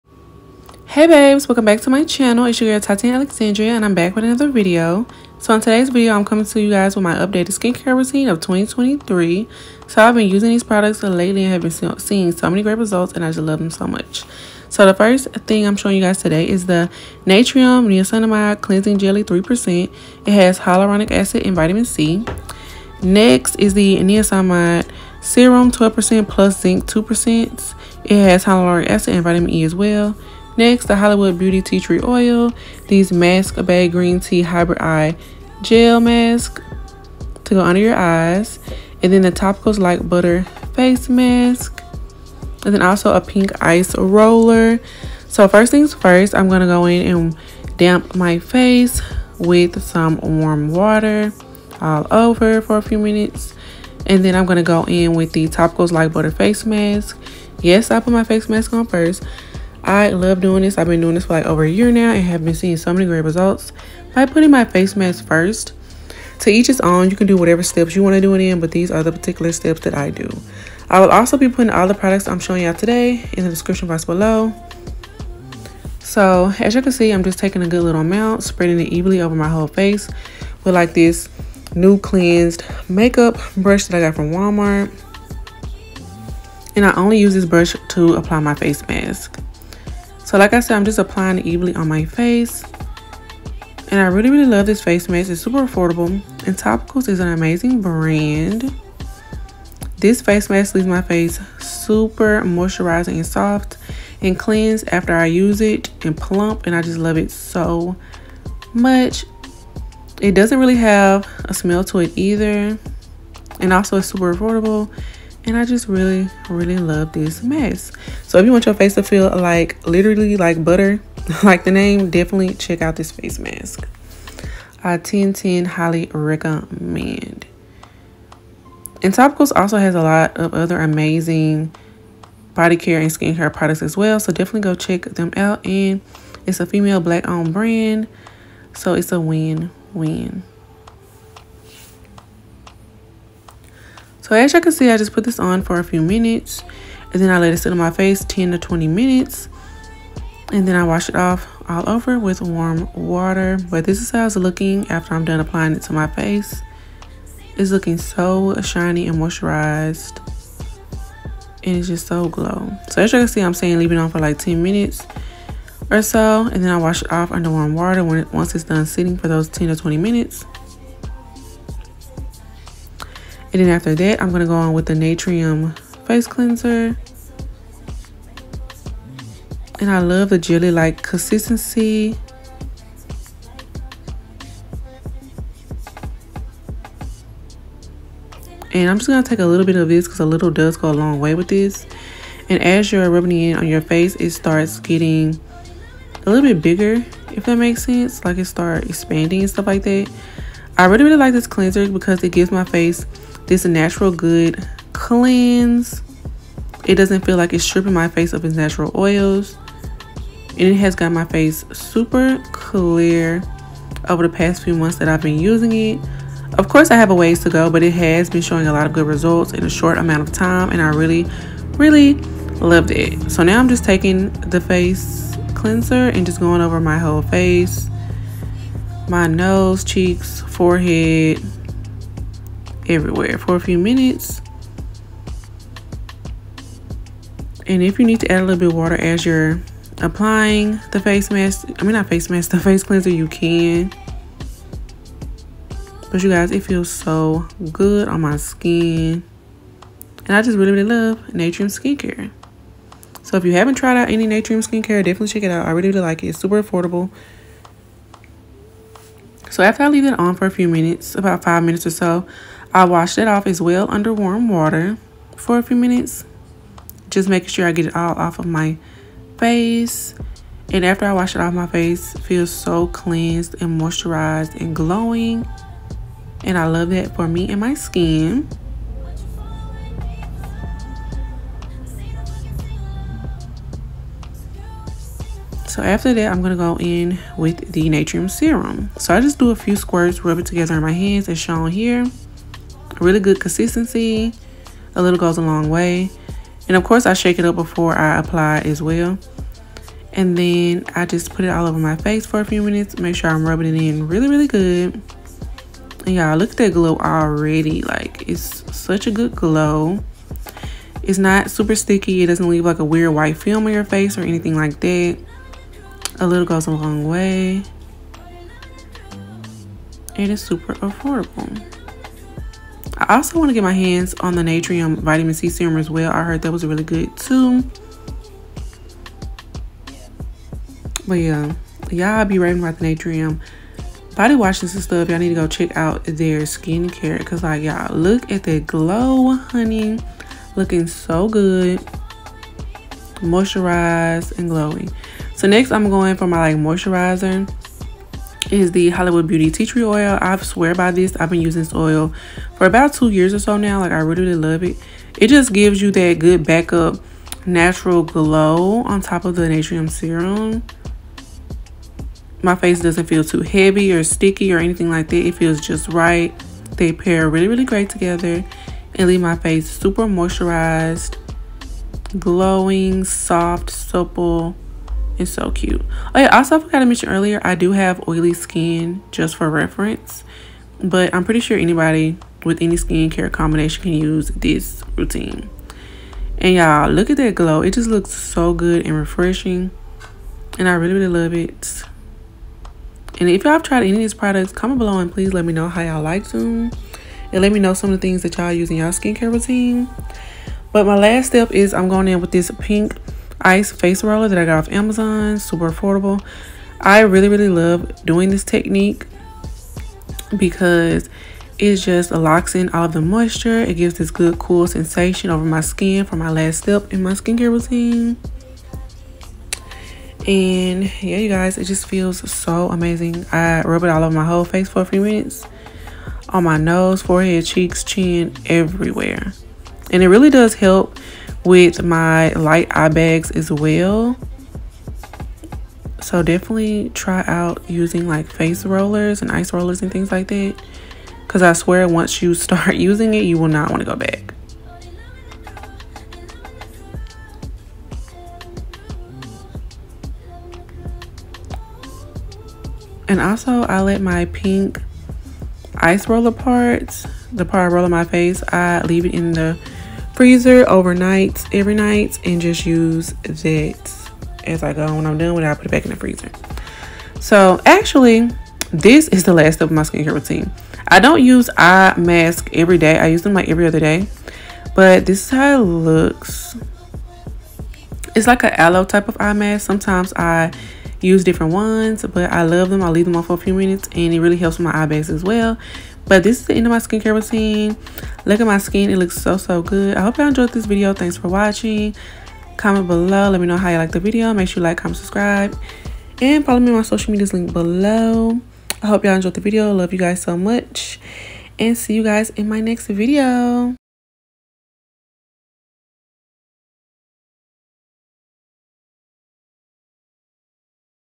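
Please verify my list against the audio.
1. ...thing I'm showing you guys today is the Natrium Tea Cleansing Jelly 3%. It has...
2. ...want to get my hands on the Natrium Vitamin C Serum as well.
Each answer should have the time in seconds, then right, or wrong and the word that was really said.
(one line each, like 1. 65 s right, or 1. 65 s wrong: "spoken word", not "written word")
1. 15 s wrong: "Niacinamide", not "Tea"
2. 323 s right.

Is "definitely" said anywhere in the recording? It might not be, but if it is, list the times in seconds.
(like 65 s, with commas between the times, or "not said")
122 s, 134 s, 255 s, 436 s.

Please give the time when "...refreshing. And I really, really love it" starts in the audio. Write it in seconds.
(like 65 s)
388 s.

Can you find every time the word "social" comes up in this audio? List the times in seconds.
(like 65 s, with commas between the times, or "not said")
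496 s.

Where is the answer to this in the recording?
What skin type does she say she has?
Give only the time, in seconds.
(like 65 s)
378 s.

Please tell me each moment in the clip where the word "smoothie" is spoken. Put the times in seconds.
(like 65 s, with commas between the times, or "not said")
not said.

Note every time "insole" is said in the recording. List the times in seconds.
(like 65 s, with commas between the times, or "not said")
not said.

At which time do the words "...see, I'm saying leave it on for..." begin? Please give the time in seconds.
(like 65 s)
163 s.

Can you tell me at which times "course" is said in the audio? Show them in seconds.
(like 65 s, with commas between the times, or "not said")
216 s, 296 s.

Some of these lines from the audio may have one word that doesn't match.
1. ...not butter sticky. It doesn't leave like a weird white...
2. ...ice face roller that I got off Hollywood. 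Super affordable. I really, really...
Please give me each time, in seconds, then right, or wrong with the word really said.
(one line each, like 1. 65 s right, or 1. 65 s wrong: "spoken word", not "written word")
1. 311 s wrong: "super", not "butter"
2. 403 s wrong: "Amazon", not "Hollywood".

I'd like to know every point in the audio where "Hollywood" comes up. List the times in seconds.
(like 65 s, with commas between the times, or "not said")
30 s, 348 s.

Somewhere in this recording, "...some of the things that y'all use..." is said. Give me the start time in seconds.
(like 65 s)
397 s.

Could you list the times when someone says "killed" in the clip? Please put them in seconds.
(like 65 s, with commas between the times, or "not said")
not said.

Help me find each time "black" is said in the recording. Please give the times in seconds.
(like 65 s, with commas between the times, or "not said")
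136 s.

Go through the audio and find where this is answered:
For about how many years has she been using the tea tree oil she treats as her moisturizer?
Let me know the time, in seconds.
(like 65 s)
352 s.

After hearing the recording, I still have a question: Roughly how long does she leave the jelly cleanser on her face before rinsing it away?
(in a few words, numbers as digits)
About five minutes.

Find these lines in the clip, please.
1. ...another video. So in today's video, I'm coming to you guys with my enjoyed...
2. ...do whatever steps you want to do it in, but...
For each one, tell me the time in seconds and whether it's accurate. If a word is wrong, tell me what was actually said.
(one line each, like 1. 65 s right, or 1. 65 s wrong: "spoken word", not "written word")
1. 4 s wrong: "updated", not "enjoyed"
2. 67 s right.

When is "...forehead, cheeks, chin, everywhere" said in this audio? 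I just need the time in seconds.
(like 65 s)
427 s.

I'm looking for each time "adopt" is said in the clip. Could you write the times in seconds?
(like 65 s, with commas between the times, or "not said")
not said.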